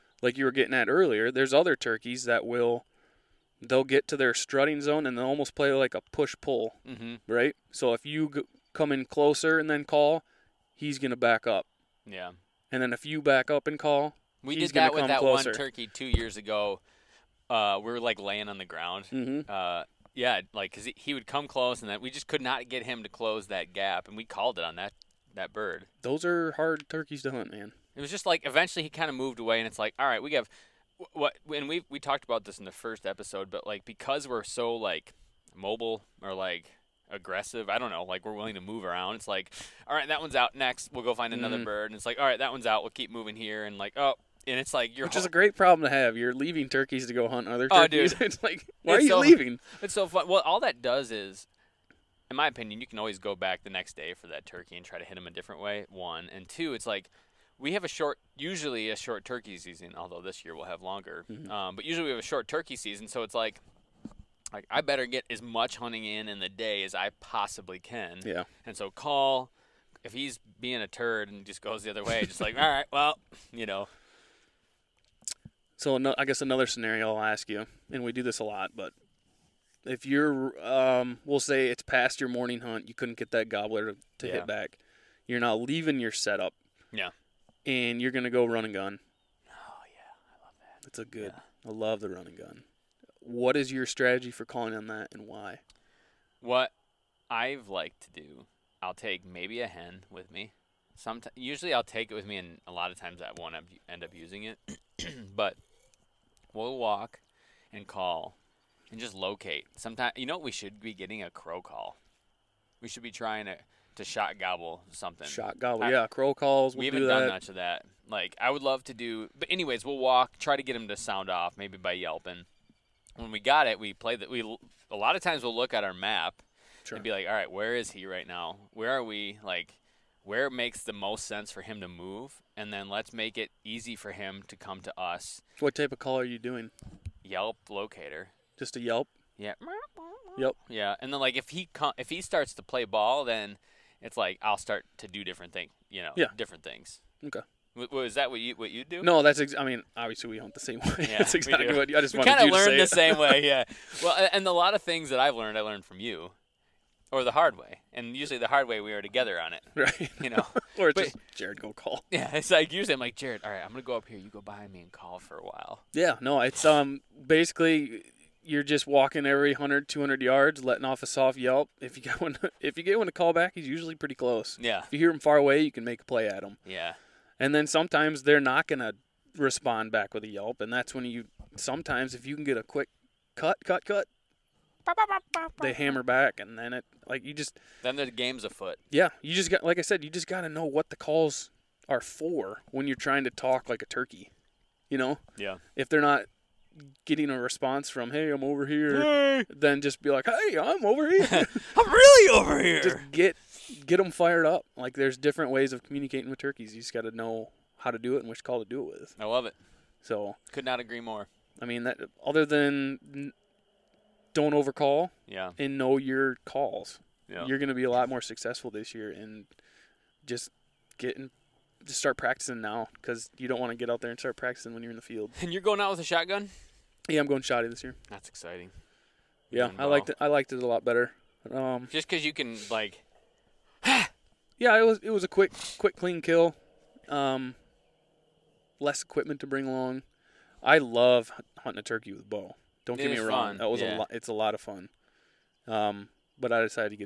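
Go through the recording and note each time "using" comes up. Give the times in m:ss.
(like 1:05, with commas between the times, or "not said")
1:44.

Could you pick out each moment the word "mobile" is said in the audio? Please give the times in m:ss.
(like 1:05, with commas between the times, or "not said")
0:35.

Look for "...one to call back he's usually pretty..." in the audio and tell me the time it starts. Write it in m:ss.
2:52.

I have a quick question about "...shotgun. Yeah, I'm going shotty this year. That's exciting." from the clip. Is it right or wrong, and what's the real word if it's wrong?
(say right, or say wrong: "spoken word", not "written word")
right.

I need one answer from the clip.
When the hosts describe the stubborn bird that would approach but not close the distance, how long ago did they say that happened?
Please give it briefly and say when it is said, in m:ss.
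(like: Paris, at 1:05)
2 years ago, at 0:15.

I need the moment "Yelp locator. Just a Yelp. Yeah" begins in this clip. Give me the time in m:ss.
2:17.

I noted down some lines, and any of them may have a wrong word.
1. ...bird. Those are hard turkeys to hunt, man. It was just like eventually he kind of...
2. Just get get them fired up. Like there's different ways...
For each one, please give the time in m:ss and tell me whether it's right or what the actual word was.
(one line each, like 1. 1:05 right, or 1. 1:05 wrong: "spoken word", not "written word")
1. 0:25 right
2. 3:22 right.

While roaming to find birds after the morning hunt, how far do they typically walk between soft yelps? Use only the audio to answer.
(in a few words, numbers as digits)
100 to 200 yards.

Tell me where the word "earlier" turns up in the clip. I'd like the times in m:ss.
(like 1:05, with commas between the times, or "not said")
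0:00.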